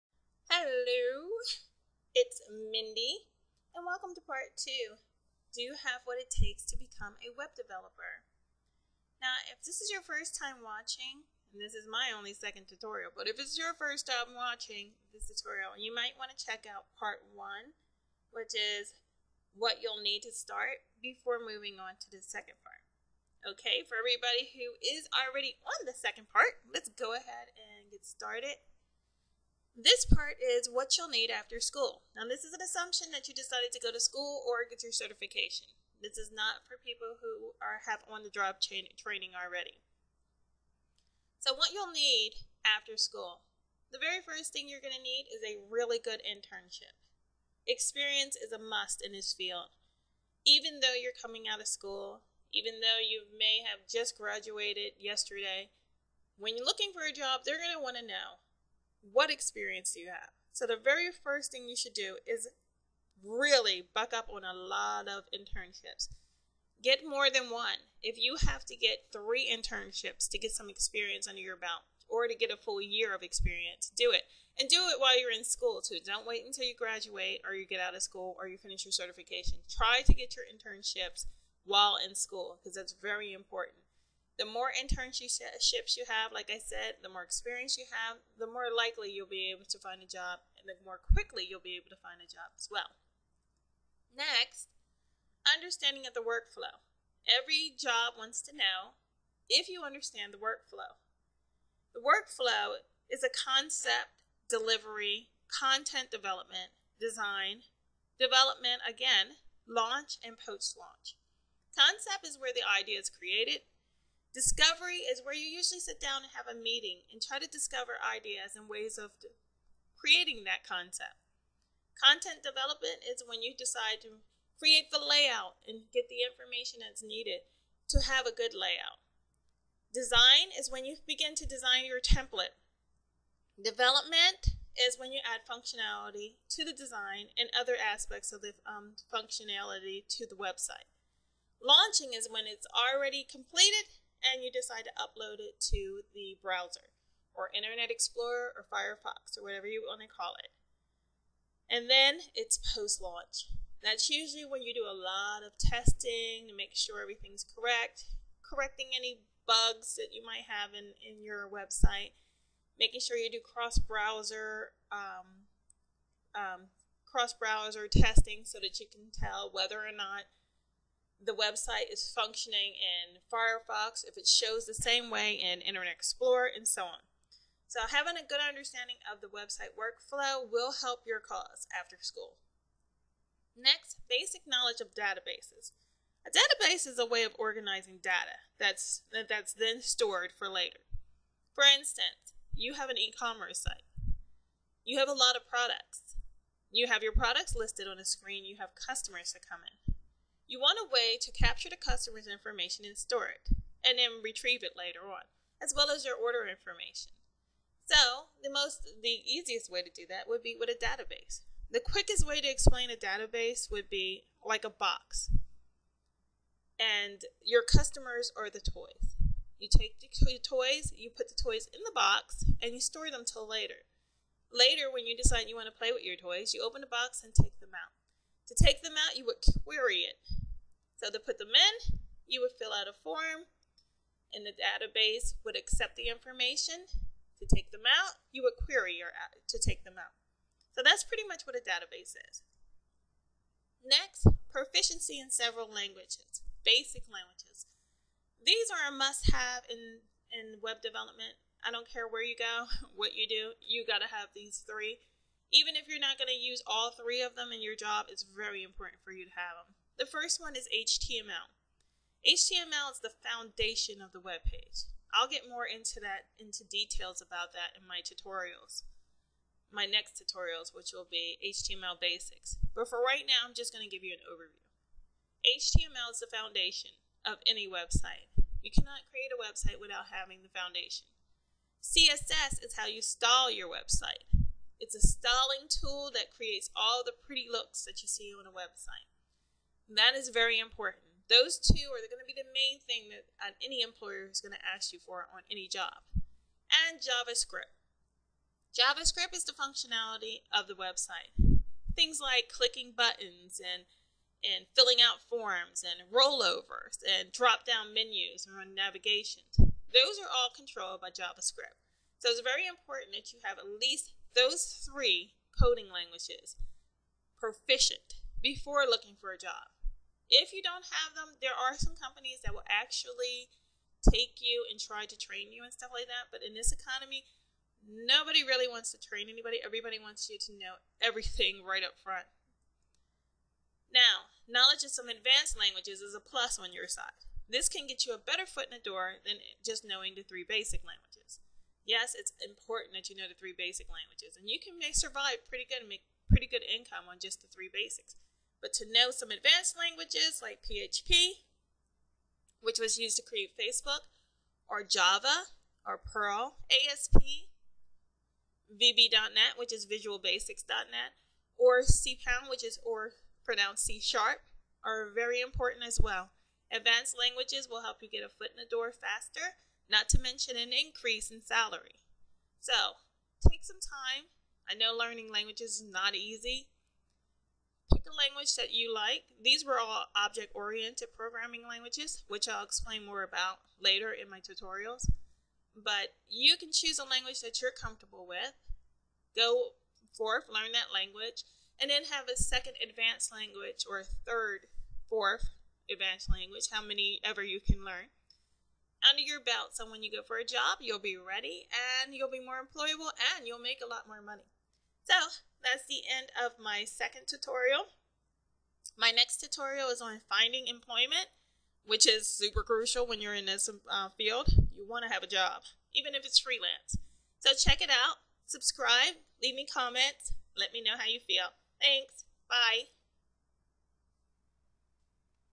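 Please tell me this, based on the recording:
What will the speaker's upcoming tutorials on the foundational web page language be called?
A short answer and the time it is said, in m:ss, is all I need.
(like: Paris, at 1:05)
HTML basics, at 4:31.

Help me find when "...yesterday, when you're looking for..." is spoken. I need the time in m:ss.
0:54.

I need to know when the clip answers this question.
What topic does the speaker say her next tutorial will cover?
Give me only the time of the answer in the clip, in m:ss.
6:50.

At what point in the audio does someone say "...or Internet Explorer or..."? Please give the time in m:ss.
2:27.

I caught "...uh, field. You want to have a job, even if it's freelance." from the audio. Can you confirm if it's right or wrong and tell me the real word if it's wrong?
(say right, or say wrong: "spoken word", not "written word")
right.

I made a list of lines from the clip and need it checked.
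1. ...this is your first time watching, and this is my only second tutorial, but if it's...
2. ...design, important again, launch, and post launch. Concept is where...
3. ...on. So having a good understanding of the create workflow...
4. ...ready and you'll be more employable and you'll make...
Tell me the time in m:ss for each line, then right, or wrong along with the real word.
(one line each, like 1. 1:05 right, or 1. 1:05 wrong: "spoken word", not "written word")
1. 0:09 right
2. 1:46 wrong: "development", not "important"
3. 2:56 wrong: "website", not "create"
4. 6:41 right.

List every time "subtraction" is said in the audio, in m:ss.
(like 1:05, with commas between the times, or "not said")
not said.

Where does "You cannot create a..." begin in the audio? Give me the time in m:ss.
4:38.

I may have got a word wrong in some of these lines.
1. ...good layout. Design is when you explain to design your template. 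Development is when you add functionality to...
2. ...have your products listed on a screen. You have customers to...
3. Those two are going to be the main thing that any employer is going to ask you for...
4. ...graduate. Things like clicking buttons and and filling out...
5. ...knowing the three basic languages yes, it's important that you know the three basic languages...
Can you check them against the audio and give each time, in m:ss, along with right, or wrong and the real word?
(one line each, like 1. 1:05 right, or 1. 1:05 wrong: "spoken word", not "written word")
1. 2:08 wrong: "begin", not "explain"
2. 3:16 right
3. 4:51 right
4. 5:00 wrong: "website", not "graduate"
5. 5:39 right.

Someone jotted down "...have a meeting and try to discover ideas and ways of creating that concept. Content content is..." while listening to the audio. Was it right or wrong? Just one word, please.
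wrong.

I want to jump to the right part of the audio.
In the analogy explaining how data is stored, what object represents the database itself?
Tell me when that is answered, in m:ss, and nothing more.
3:34.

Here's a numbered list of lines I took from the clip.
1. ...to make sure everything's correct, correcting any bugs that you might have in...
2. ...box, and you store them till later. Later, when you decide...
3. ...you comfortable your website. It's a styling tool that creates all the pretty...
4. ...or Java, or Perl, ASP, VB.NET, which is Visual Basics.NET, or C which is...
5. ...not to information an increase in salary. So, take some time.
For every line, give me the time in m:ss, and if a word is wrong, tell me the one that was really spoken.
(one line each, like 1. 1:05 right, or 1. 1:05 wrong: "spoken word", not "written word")
1. 2:36 right
2. 3:41 right
3. 4:42 wrong: "style", not "comfortable"
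4. 5:54 right
5. 6:09 wrong: "mention", not "information".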